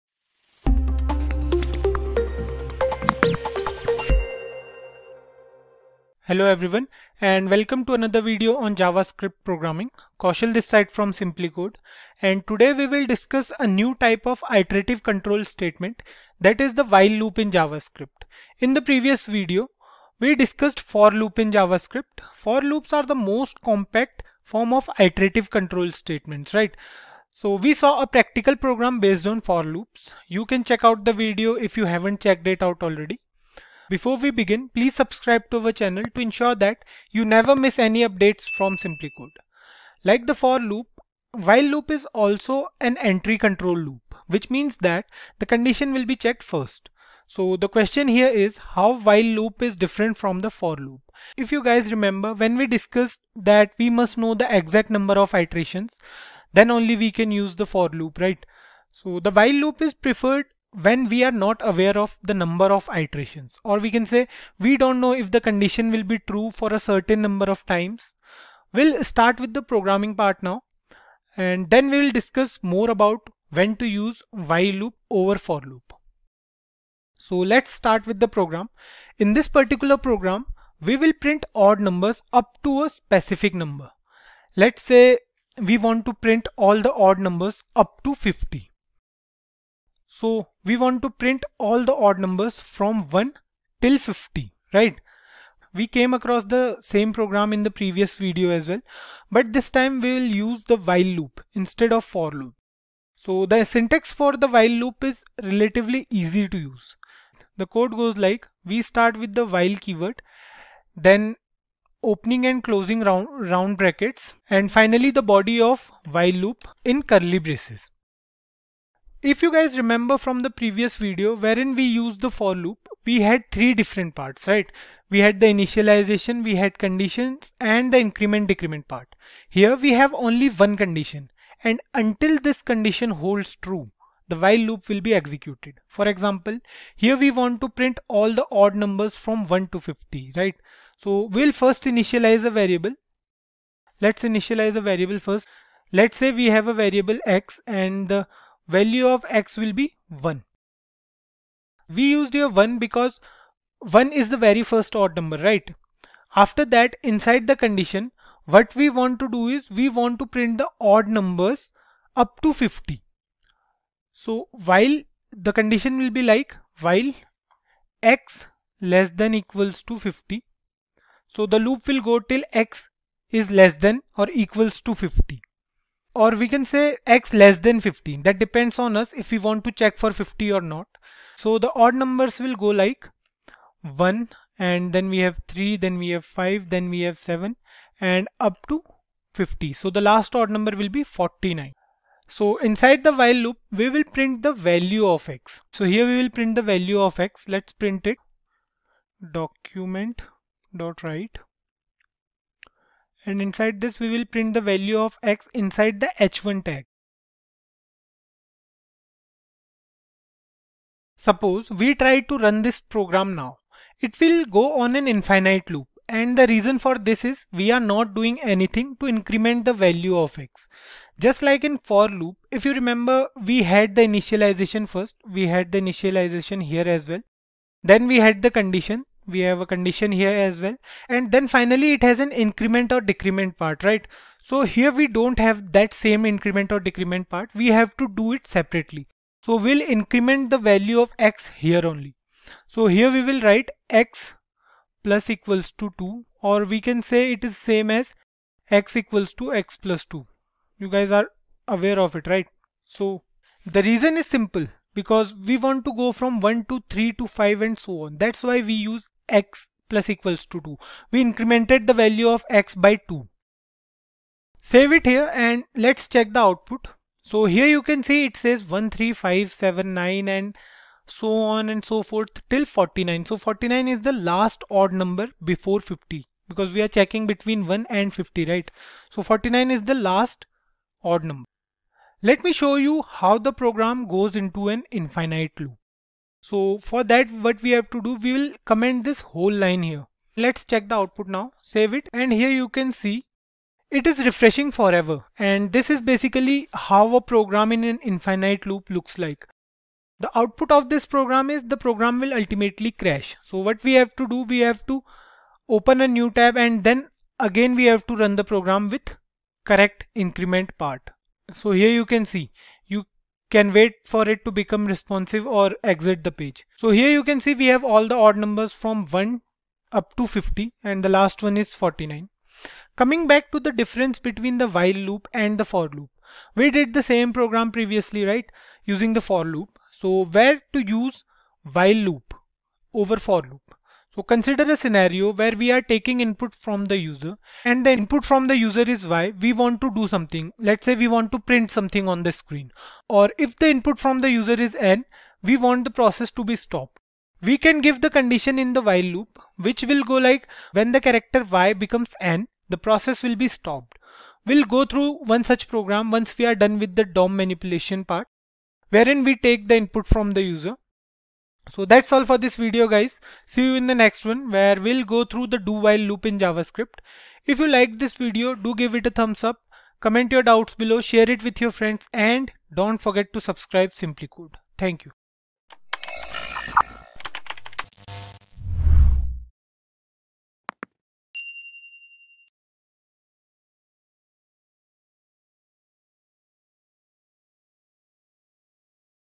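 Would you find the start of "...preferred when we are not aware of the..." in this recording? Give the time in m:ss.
0:59.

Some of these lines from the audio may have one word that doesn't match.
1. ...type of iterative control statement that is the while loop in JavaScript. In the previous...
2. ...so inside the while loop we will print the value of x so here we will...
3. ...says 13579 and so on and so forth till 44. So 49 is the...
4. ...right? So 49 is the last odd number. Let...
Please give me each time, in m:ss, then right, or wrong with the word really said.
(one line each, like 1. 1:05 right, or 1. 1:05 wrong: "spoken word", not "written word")
1. 0:14 right
2. 3:12 right
3. 4:28 wrong: "49", not "44"
4. 4:38 right.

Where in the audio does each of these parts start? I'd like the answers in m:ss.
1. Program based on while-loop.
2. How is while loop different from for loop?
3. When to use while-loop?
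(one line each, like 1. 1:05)
1. 1:17
2. 0:48
3. 5:31.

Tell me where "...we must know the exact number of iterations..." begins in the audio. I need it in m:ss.
0:53.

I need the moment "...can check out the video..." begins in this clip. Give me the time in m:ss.
0:30.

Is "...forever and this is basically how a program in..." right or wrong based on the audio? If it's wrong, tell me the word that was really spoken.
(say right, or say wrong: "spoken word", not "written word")
right.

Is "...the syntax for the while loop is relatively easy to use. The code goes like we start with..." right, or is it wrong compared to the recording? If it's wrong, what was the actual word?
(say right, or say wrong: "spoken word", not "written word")
right.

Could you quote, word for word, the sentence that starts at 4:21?
We incremented the value of x by 2.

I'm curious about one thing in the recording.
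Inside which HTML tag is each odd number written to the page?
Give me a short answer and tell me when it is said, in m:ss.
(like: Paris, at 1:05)
h1, at 3:26.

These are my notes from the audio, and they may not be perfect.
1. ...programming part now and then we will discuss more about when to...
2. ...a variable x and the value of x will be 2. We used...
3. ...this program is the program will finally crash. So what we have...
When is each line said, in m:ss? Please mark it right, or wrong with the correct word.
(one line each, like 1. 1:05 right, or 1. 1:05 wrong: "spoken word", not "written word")
1. 1:09 right
2. 2:26 wrong: "1", not "2"
3. 5:00 wrong: "ultimately", not "finally".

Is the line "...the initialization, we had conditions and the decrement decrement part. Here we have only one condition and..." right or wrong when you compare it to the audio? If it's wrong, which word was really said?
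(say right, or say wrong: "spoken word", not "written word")
wrong: "increment", not "decrement".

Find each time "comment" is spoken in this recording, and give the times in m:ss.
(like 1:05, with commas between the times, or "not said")
4:48, 6:09.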